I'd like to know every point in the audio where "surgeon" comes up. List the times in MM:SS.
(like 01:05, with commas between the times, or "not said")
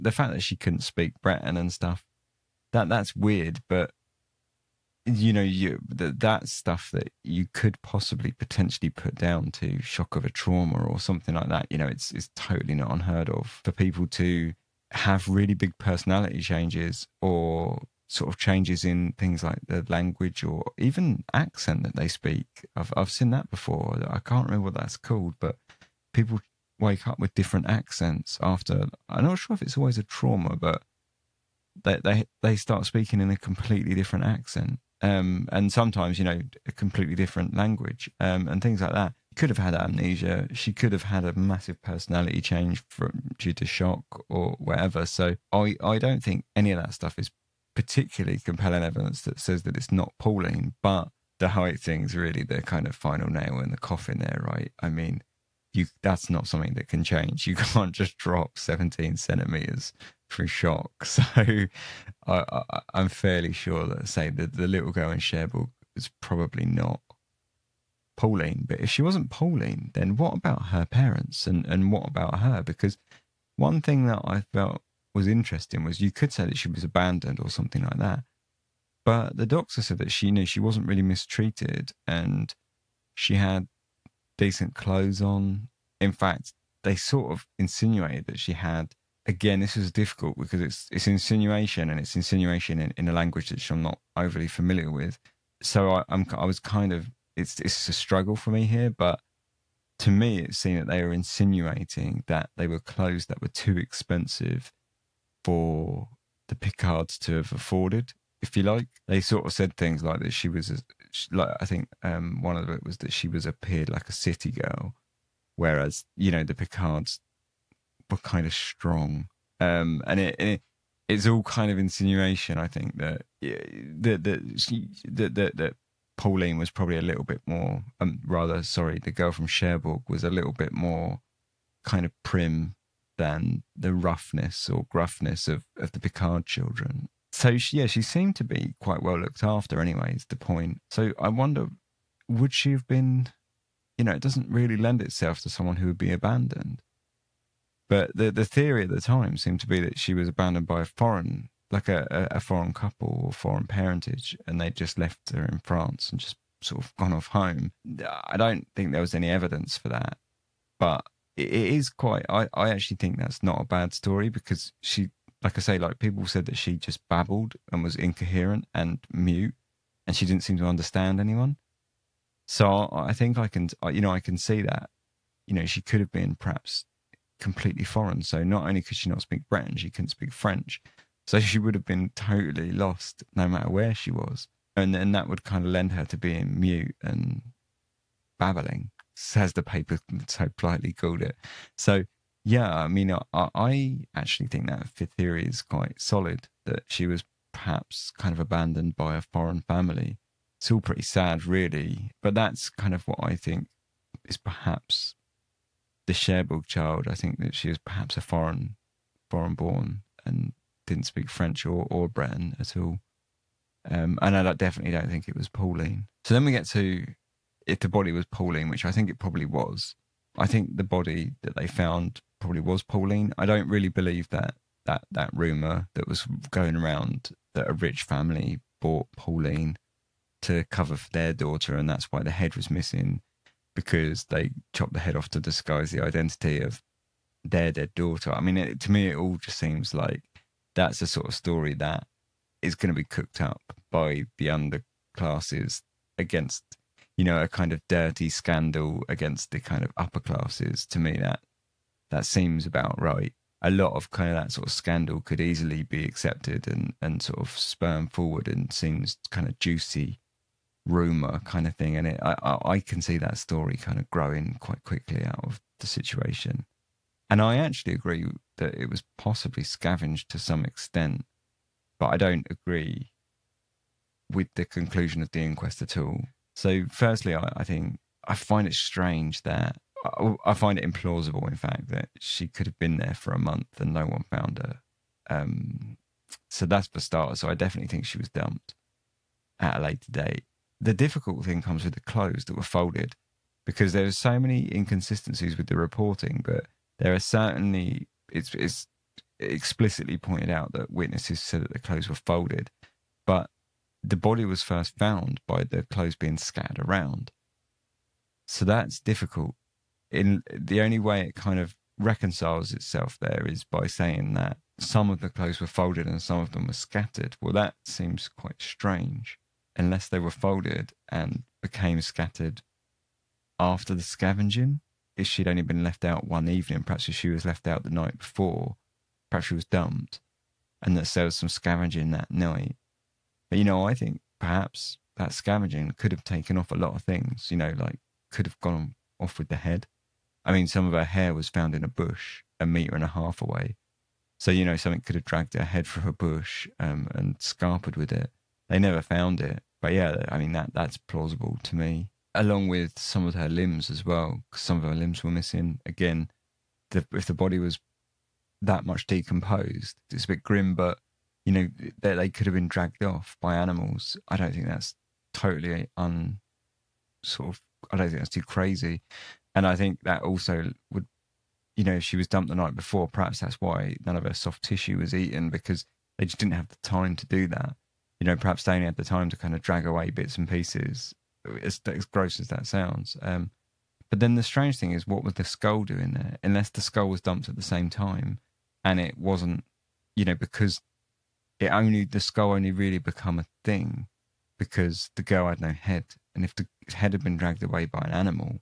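not said.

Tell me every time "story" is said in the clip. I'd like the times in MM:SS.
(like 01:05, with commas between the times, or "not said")
02:43, 04:01, 04:23.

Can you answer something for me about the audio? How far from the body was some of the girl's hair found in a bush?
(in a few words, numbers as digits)
A metre and a half.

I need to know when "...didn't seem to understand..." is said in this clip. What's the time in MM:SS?
02:50.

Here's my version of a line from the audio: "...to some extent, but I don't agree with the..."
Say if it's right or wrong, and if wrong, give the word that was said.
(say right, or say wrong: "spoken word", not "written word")
right.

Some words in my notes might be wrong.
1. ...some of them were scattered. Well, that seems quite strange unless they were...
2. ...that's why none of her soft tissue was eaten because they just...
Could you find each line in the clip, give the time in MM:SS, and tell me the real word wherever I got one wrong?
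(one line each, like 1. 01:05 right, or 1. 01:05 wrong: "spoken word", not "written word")
1. 05:16 right
2. 06:13 right.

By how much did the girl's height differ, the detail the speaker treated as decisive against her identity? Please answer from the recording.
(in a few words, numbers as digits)
17 centimeters.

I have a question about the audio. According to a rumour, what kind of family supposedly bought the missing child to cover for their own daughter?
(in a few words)
A rich family.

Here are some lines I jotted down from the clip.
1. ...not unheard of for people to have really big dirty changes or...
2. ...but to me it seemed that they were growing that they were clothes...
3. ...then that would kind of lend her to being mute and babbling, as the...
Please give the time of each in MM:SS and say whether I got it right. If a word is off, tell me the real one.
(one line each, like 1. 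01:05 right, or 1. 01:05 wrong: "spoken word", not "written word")
1. 00:12 wrong: "personality", not "dirty"
2. 01:38 wrong: "insinuating", not "growing"
3. 03:04 right.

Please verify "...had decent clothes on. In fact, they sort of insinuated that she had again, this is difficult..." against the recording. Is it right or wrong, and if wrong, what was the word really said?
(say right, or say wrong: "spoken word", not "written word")
right.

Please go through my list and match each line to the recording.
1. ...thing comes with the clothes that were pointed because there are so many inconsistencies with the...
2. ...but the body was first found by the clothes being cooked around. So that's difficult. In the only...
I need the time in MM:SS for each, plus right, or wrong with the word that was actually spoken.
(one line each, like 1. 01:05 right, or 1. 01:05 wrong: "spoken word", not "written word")
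1. 04:51 wrong: "folded", not "pointed"
2. 05:03 wrong: "scattered", not "cooked".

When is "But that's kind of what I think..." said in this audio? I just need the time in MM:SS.
03:22.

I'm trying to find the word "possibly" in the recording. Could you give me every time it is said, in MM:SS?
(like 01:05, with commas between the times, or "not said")
00:07, 04:29.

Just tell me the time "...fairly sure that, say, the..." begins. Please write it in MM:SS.
01:03.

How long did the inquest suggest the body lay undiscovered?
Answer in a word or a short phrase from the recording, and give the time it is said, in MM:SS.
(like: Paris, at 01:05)
A month, at 04:43.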